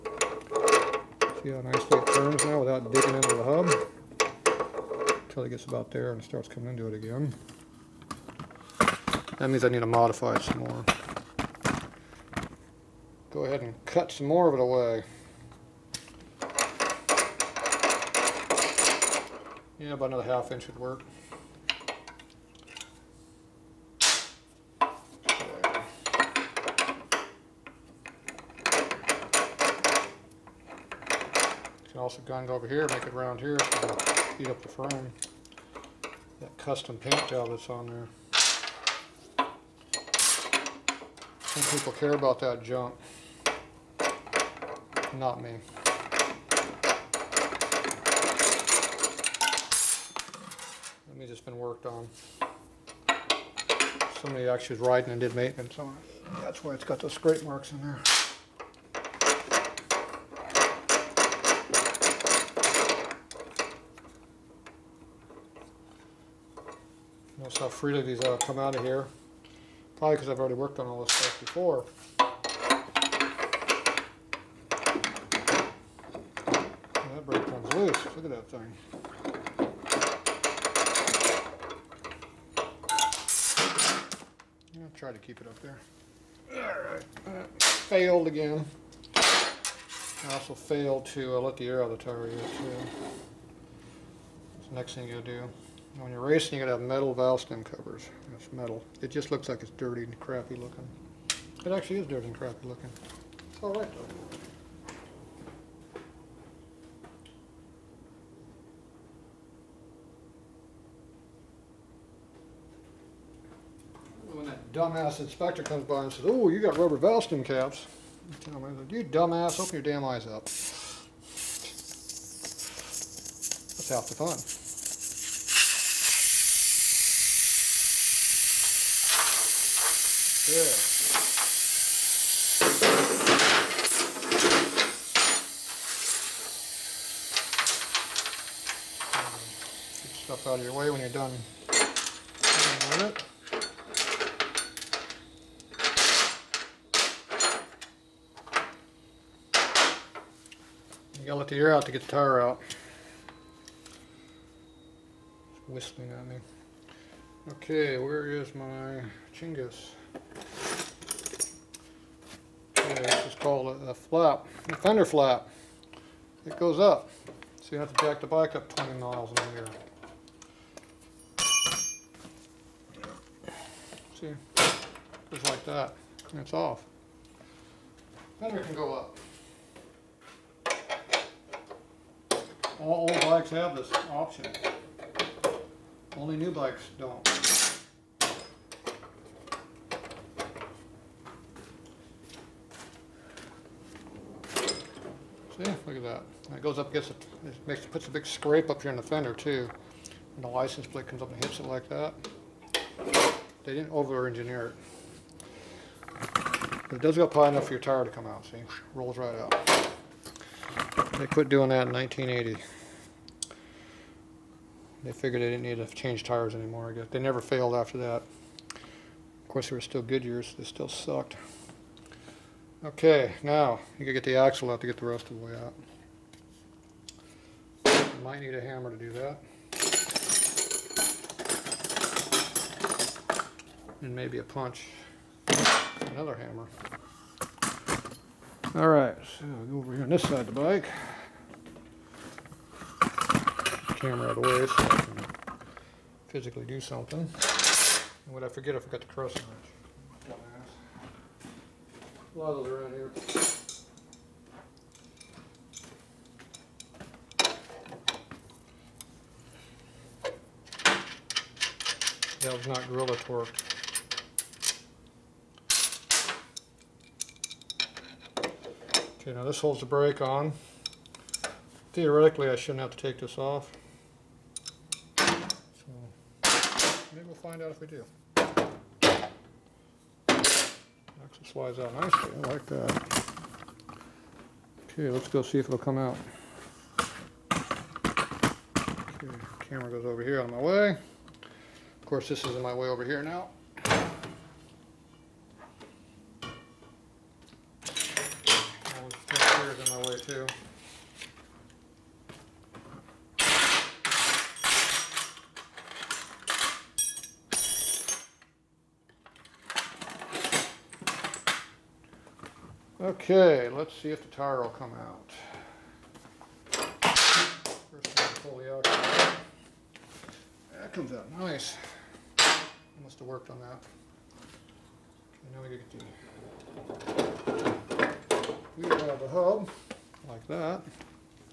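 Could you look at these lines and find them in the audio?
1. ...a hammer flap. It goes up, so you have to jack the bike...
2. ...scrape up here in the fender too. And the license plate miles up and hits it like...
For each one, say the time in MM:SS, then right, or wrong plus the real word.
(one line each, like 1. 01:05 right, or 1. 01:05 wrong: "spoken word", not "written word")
1. 02:44 wrong: "fender", not "hammer"
2. 03:18 wrong: "comes", not "miles".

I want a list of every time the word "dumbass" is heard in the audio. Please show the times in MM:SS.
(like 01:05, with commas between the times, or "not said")
01:54, 01:59.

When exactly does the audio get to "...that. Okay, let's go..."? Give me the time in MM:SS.
04:42.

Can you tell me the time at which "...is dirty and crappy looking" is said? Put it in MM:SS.
01:41.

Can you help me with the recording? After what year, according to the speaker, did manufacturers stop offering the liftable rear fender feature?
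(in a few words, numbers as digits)
1980.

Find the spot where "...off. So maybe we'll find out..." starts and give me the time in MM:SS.
04:33.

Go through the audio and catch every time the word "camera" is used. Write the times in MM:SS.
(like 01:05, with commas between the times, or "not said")
04:03, 04:49.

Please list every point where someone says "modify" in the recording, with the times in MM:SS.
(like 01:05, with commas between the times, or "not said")
00:09.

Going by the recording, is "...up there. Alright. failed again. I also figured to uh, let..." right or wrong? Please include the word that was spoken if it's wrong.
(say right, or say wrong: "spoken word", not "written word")
wrong: "failed", not "figured".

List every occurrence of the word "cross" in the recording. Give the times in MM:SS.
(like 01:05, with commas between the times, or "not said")
04:09.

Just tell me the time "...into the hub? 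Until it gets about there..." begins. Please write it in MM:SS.
00:03.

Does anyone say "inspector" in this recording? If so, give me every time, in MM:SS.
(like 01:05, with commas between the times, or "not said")
01:55.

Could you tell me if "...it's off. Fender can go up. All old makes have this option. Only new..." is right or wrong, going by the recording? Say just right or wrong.
wrong.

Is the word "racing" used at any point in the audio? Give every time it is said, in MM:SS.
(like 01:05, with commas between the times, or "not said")
01:36.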